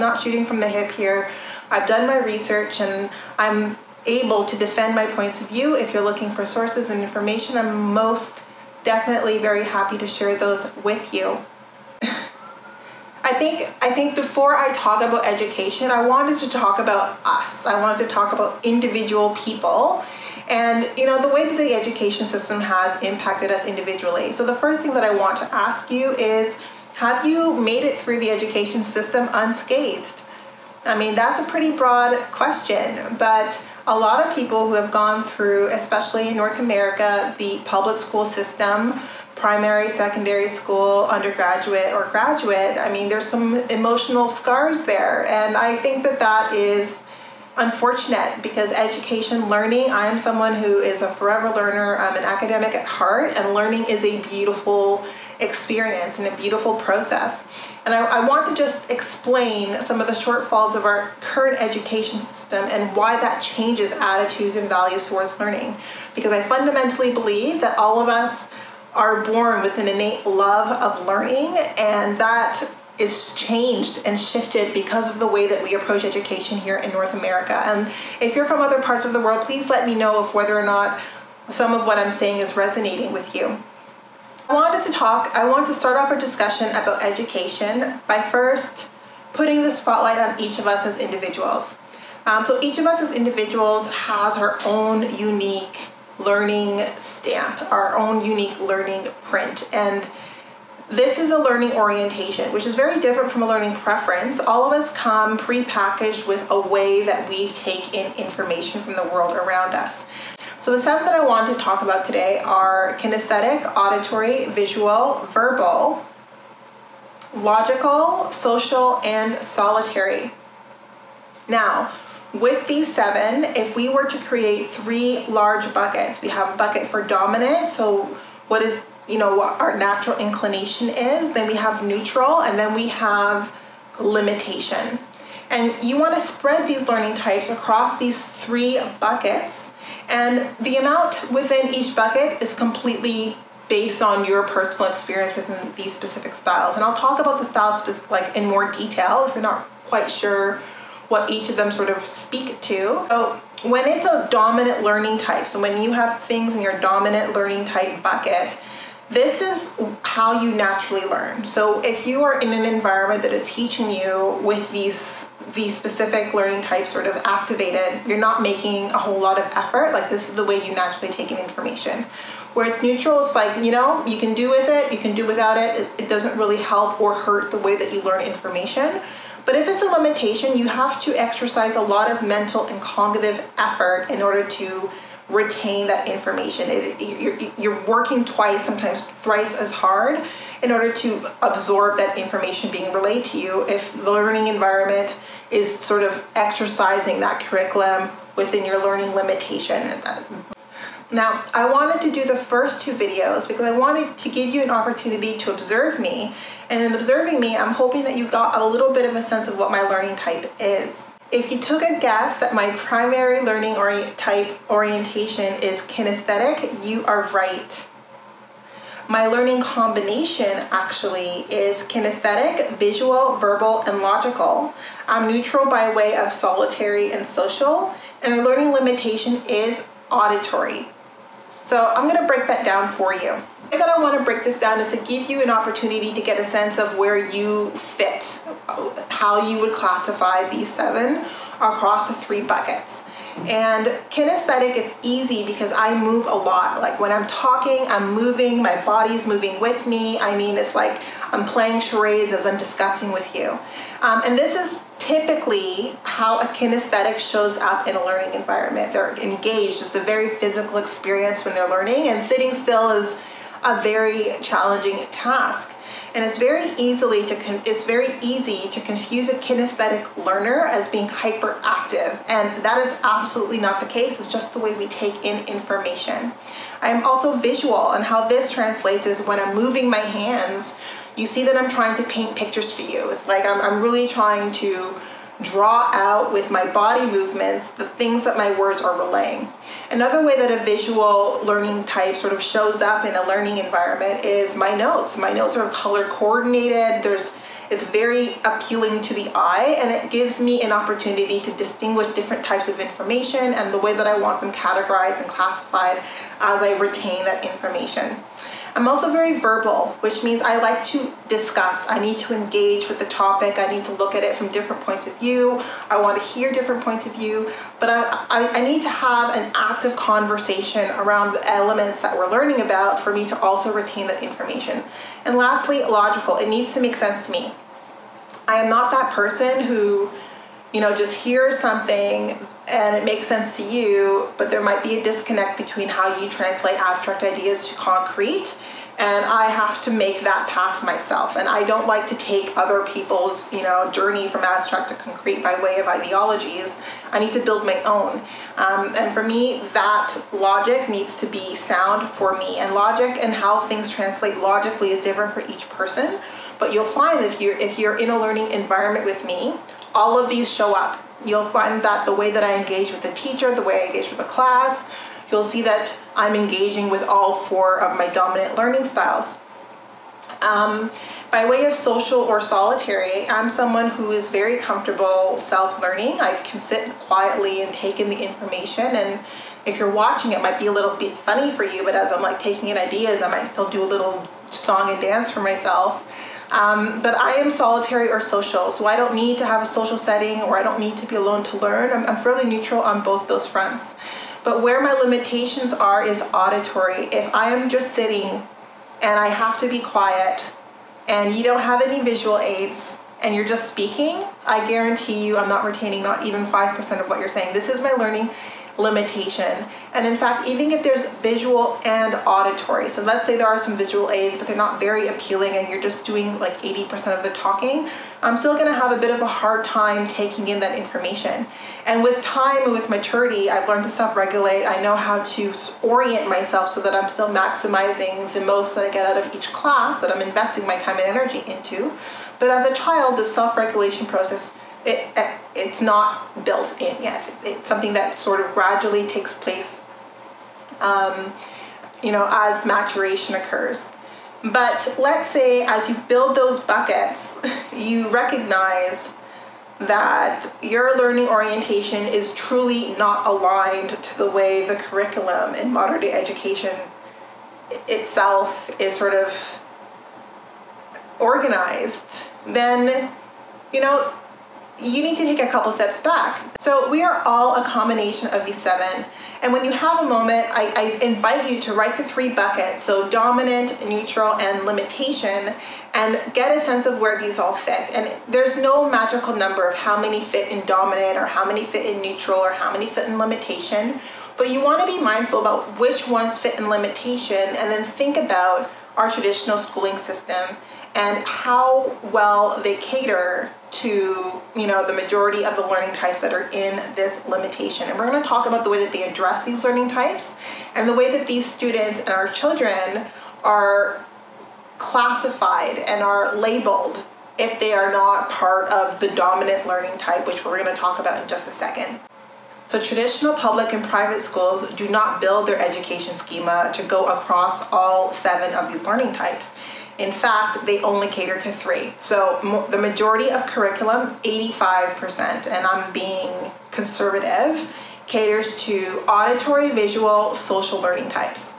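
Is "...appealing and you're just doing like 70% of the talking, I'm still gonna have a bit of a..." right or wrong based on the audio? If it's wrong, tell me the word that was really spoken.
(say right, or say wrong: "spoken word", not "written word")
wrong: "80", not "70".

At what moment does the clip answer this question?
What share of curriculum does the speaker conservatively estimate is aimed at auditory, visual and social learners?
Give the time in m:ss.
8:44.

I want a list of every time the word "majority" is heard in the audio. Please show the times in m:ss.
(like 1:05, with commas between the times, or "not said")
8:14, 8:42.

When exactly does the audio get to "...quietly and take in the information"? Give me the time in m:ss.
6:16.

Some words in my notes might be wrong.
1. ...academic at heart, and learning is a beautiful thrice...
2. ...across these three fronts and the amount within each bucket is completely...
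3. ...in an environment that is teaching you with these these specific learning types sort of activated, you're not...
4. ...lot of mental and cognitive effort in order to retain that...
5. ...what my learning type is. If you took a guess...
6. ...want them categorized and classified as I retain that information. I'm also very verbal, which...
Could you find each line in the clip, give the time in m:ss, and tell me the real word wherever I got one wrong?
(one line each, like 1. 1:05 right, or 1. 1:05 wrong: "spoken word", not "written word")
1. 0:52 wrong: "experience", not "thrice"
2. 2:17 wrong: "buckets", not "fronts"
3. 2:42 right
4. 3:01 right
5. 3:29 right
6. 5:04 right.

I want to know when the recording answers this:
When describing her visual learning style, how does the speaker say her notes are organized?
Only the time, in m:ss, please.
4:55.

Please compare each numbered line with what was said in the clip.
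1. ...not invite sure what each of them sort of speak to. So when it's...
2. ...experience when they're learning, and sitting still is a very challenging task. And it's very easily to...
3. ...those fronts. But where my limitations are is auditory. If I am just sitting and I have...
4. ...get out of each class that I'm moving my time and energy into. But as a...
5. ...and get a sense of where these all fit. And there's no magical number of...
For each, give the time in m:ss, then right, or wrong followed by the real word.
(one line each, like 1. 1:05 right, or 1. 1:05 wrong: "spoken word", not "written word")
1. 2:29 wrong: "quite", not "invite"
2. 4:20 right
3. 6:33 right
4. 7:08 wrong: "investing", not "moving"
5. 7:55 right.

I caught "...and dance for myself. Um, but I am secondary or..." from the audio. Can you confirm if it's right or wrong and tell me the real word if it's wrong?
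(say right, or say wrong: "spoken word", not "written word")
wrong: "solitary", not "secondary".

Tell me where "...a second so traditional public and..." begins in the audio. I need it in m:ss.
8:31.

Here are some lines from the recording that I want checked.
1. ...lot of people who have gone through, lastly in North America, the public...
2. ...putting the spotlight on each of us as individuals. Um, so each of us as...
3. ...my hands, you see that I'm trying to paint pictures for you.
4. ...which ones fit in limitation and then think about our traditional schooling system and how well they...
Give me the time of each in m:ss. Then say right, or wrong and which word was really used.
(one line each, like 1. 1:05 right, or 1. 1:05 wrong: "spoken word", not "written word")
1. 0:33 wrong: "especially", not "lastly"
2. 1:29 right
3. 4:39 right
4. 8:05 right.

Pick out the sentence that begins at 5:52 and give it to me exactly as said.
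And logic and how things translate logically is different for each person.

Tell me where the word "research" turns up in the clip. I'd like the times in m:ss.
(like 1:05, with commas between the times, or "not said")
0:02.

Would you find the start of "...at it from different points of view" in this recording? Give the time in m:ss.
5:14.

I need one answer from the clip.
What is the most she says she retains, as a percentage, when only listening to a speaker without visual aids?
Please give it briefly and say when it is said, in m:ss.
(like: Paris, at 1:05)
5%, at 6:46.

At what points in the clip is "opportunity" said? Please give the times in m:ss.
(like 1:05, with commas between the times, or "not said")
3:24, 3:55, 5:00.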